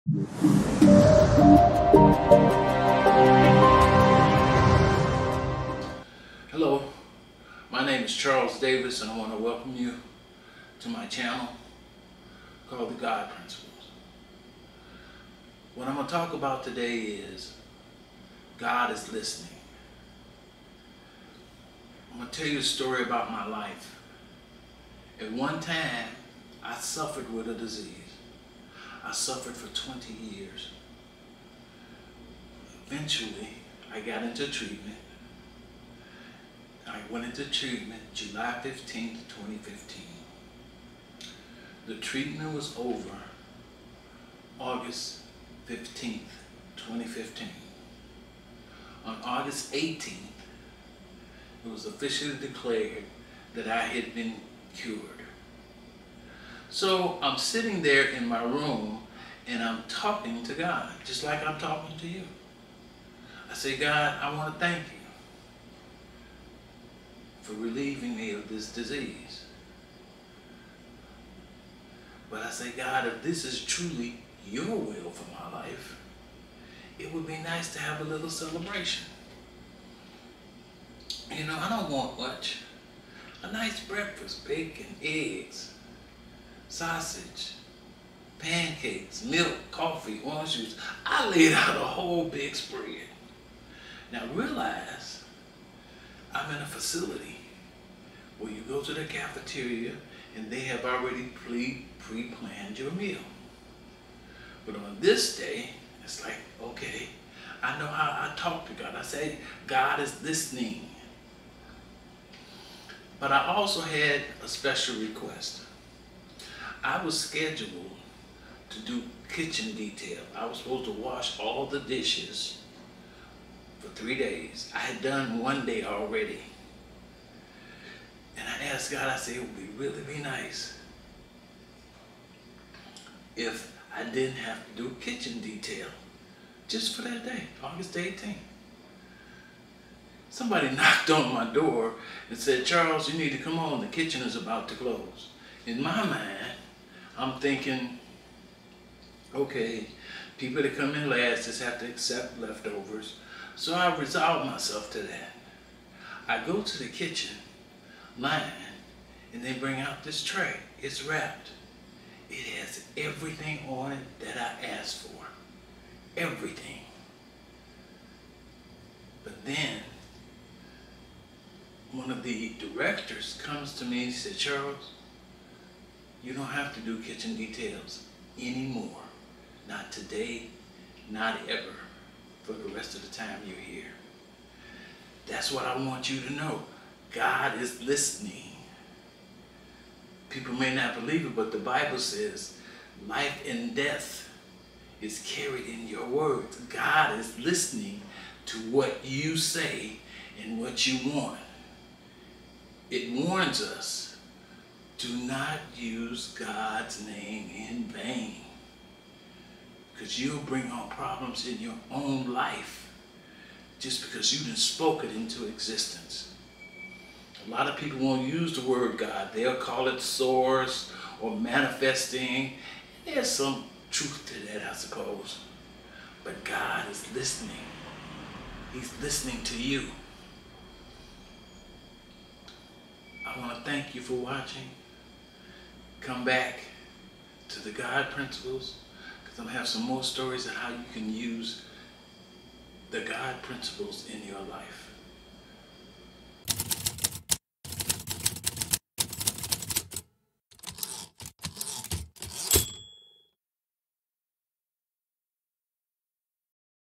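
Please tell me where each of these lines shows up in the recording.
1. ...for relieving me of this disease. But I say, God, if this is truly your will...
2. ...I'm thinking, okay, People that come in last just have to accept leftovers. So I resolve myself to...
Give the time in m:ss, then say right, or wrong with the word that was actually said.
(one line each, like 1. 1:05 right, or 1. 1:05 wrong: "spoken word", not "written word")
1. 1:07 right
2. 2:27 right.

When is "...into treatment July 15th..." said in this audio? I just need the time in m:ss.
0:37.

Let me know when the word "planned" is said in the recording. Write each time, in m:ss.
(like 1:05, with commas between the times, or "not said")
1:41.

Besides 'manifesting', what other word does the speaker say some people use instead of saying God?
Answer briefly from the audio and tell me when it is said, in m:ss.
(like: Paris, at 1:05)
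Source, at 3:40.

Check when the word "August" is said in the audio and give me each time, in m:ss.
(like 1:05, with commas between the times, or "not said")
0:44, 0:49, 2:17.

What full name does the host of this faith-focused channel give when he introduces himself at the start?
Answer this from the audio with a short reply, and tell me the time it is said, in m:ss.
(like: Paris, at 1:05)
Charles Davis, at 0:08.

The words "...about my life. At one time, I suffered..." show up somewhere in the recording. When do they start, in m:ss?
0:23.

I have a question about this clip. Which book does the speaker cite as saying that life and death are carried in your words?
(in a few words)
The Bible.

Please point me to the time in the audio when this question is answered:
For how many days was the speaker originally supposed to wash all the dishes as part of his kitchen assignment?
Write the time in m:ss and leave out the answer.
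2:03.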